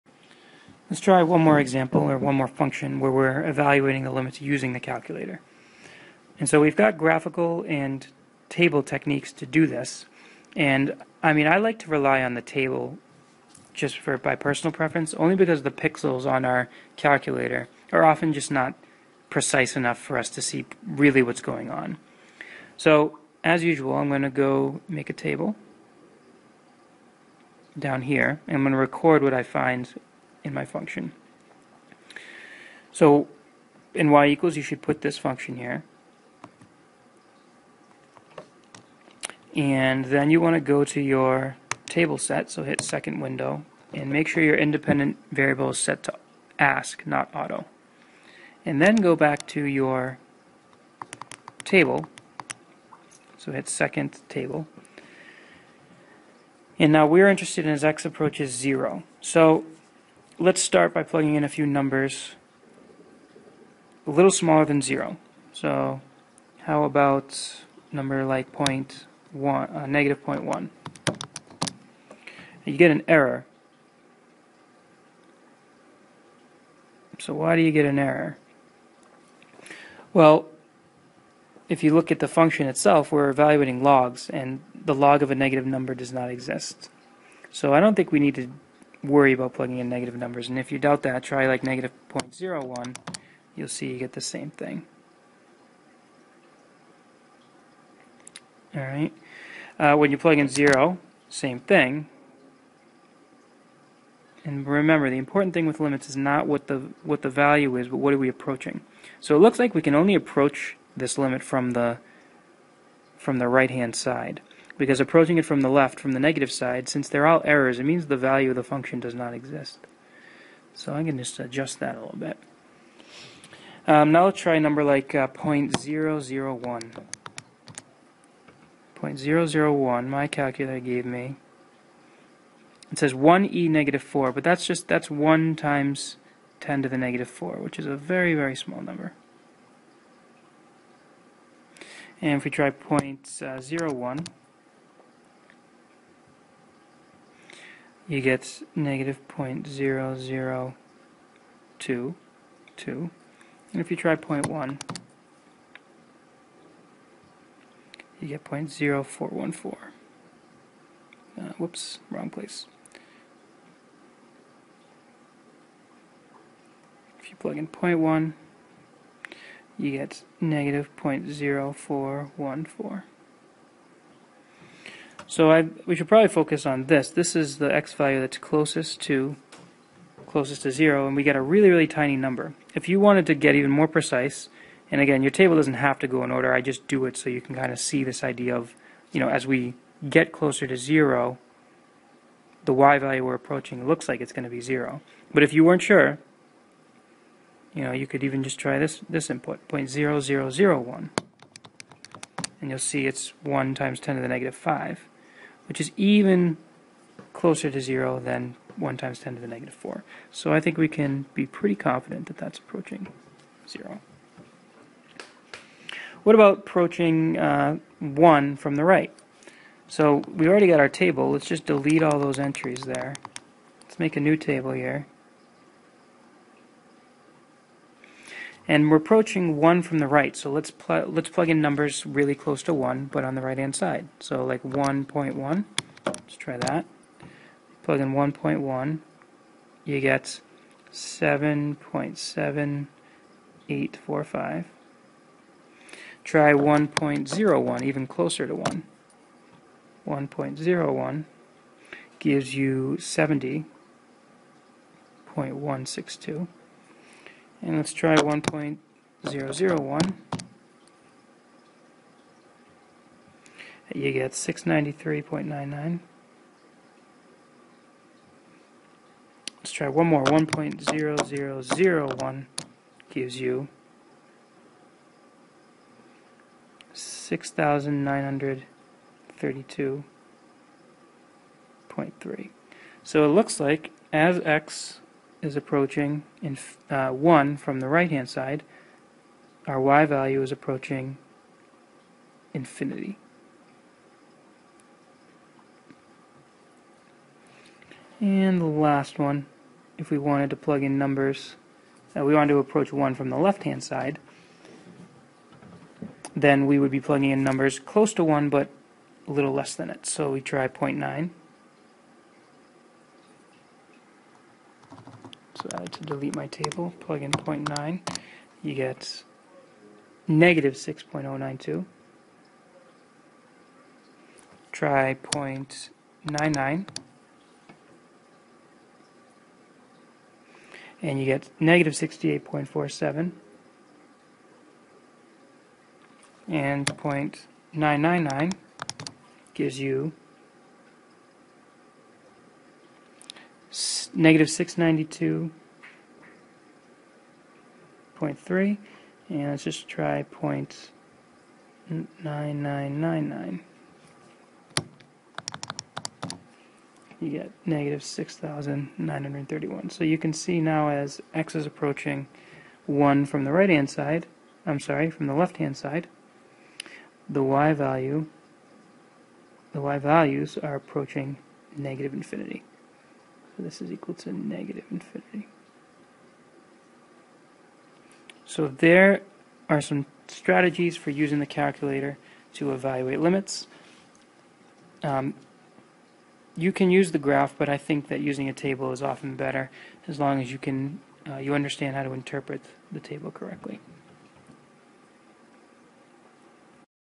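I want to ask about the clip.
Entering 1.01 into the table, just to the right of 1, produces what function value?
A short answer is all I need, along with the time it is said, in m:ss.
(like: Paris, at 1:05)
70.162, at 4:12.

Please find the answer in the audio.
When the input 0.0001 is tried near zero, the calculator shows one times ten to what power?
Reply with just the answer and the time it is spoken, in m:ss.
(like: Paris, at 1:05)
negative 5, at 3:24.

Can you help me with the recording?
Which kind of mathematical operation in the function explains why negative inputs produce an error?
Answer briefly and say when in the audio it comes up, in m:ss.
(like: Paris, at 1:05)
logs, at 1:23.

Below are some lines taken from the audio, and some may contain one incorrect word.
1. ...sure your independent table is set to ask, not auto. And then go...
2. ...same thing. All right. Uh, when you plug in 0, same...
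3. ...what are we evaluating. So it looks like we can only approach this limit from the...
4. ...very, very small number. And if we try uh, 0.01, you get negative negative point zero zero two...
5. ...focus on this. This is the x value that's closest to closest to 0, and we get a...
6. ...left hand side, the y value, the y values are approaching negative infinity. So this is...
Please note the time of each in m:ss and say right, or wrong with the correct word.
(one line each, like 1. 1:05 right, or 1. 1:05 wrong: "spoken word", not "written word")
1. 0:44 wrong: "variable", not "table"
2. 1:34 right
3. 1:47 wrong: "approaching", not "evaluating"
4. 2:17 right
5. 2:56 right
6. 6:05 right.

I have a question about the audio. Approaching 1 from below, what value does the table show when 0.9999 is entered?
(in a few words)
-6,931.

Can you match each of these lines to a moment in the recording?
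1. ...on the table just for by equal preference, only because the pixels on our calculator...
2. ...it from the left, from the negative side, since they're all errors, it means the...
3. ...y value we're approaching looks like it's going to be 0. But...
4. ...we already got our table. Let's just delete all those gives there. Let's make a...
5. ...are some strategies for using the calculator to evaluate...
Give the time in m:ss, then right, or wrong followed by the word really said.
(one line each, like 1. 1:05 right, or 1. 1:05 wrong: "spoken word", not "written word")
1. 0:12 wrong: "personal", not "equal"
2. 1:55 right
3. 3:12 right
4. 3:40 wrong: "entries", not "gives"
5. 6:19 right.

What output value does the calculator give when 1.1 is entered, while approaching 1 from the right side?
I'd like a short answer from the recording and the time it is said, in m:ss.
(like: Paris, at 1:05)
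7.7845, at 4:00.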